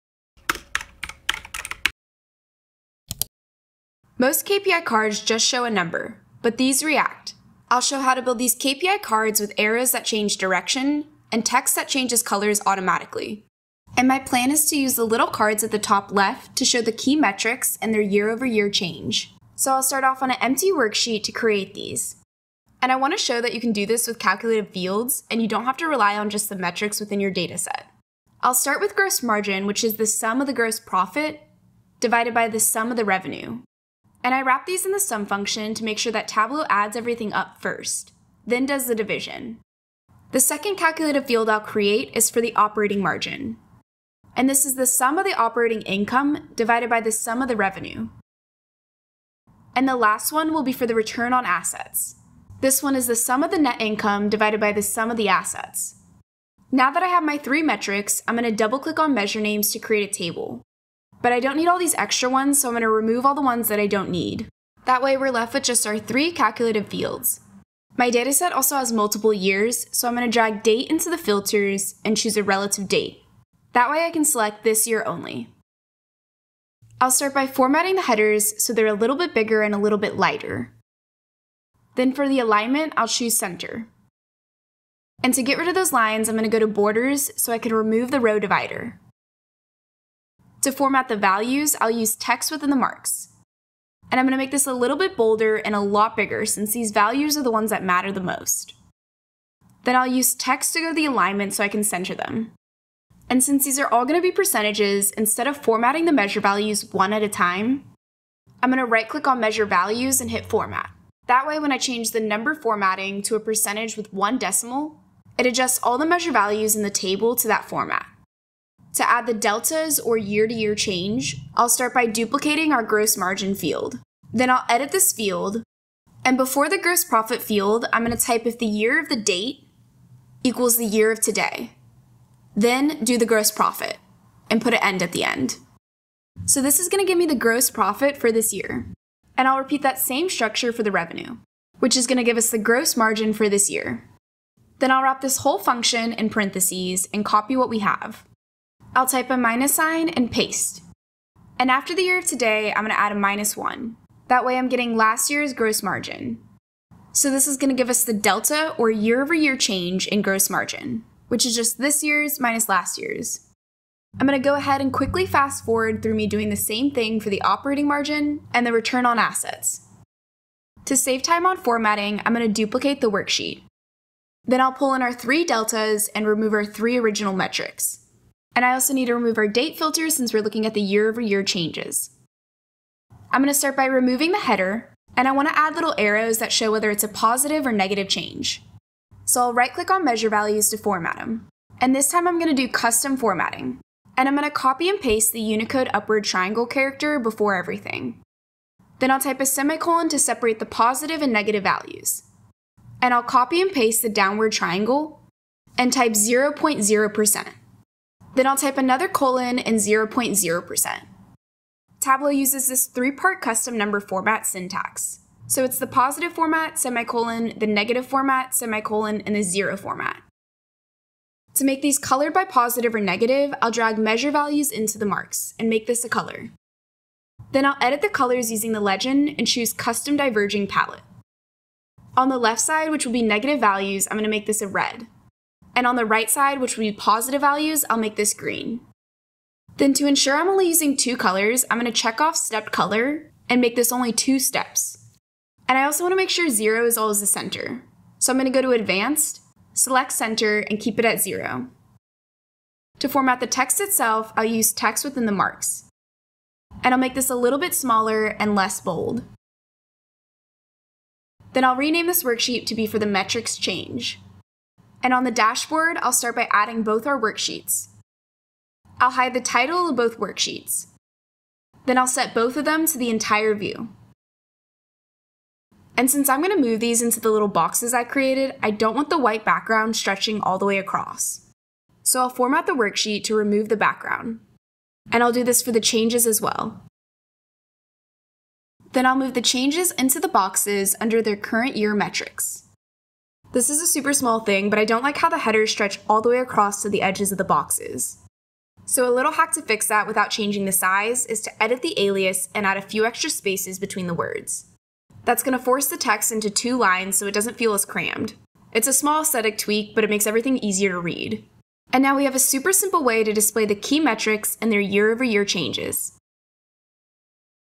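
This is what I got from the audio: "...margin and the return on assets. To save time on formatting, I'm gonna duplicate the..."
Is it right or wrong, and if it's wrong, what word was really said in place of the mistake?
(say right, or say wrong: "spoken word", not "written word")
right.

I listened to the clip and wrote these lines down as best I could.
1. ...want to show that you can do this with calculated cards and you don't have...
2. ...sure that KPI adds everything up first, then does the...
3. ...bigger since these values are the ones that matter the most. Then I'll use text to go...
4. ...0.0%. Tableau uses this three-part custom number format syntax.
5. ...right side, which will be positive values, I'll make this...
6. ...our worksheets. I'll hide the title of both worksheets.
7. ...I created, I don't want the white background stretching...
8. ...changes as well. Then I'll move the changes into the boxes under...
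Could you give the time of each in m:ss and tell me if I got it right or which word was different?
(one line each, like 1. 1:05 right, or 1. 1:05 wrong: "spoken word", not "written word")
1. 0:22 wrong: "fields", not "cards"
2. 0:35 wrong: "Tableau", not "KPI"
3. 1:36 right
4. 3:29 right
5. 3:56 right
6. 4:27 right
7. 4:37 right
8. 4:45 right.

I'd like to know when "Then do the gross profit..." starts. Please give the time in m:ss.
2:12.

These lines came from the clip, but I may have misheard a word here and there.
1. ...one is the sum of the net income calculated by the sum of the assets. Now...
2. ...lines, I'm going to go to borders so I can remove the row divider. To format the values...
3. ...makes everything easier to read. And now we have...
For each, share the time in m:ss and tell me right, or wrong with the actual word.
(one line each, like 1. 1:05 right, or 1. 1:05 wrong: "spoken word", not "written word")
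1. 0:52 wrong: "divided", not "calculated"
2. 1:25 right
3. 5:10 right.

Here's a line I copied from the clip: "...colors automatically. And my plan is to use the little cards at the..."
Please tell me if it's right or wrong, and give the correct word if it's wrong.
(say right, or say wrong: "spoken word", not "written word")
right.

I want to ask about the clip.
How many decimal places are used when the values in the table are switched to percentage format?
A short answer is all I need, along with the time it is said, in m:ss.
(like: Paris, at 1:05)
1, at 1:54.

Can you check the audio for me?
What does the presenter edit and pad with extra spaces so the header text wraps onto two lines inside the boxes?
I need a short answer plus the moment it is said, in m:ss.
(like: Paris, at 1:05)
The alias, at 5:01.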